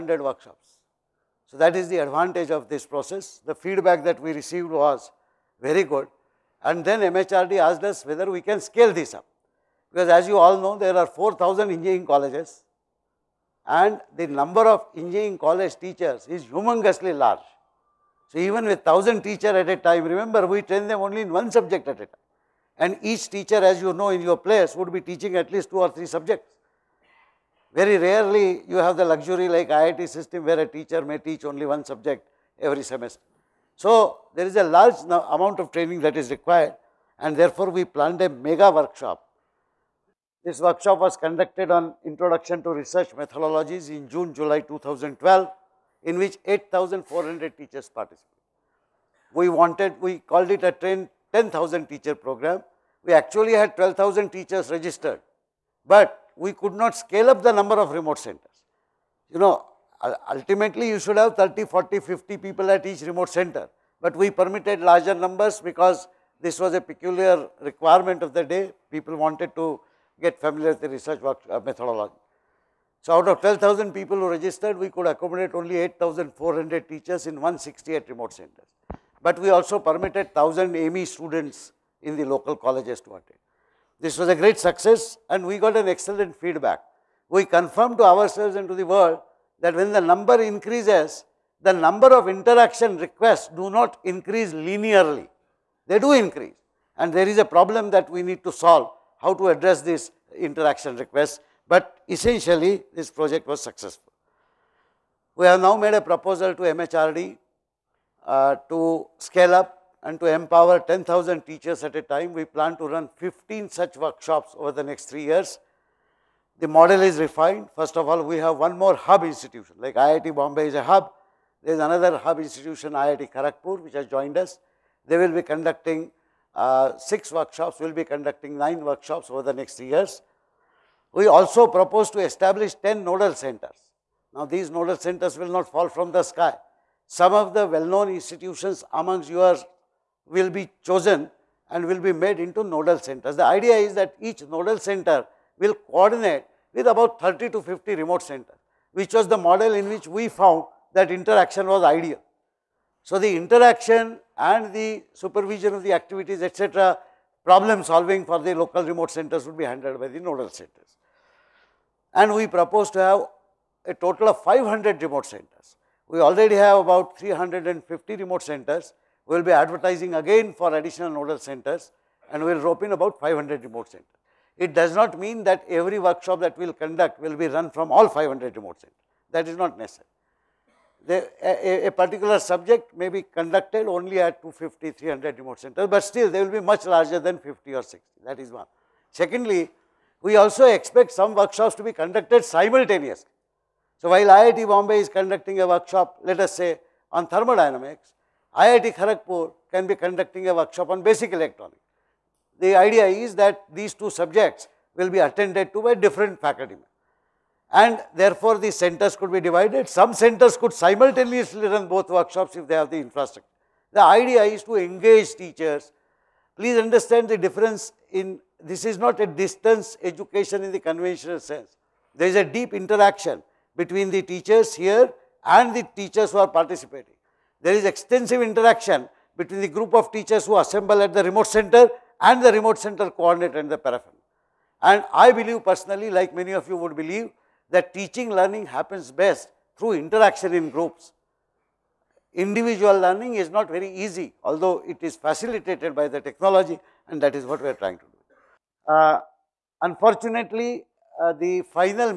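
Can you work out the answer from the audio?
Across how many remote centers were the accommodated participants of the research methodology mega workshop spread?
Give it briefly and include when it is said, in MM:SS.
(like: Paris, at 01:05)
168, at 01:17.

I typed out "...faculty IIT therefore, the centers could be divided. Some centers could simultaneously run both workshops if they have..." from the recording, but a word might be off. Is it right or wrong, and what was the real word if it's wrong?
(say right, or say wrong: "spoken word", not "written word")
wrong: "And", not "IIT".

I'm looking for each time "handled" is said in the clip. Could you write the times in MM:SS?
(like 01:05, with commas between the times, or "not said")
02:39.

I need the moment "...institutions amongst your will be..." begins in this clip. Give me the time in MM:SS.
02:18.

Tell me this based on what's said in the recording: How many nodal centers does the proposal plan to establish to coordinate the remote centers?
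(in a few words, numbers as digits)
10.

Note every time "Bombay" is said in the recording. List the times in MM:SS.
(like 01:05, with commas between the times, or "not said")
02:00, 03:14.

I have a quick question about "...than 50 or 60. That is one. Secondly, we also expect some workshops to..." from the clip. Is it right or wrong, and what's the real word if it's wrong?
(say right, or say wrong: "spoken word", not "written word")
right.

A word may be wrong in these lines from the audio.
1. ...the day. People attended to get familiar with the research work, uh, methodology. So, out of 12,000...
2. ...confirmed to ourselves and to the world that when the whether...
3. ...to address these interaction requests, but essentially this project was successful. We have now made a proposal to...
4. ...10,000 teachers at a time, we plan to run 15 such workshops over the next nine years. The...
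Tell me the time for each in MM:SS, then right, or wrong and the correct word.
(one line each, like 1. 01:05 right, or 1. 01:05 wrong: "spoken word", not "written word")
1. 01:08 wrong: "wanted", not "attended"
2. 01:27 wrong: "number", not "whether"
3. 01:39 right
4. 01:50 wrong: "three", not "nine".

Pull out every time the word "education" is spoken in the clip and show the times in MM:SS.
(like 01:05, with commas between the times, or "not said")
03:40.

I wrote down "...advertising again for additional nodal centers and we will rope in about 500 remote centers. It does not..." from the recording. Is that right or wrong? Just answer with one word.
right.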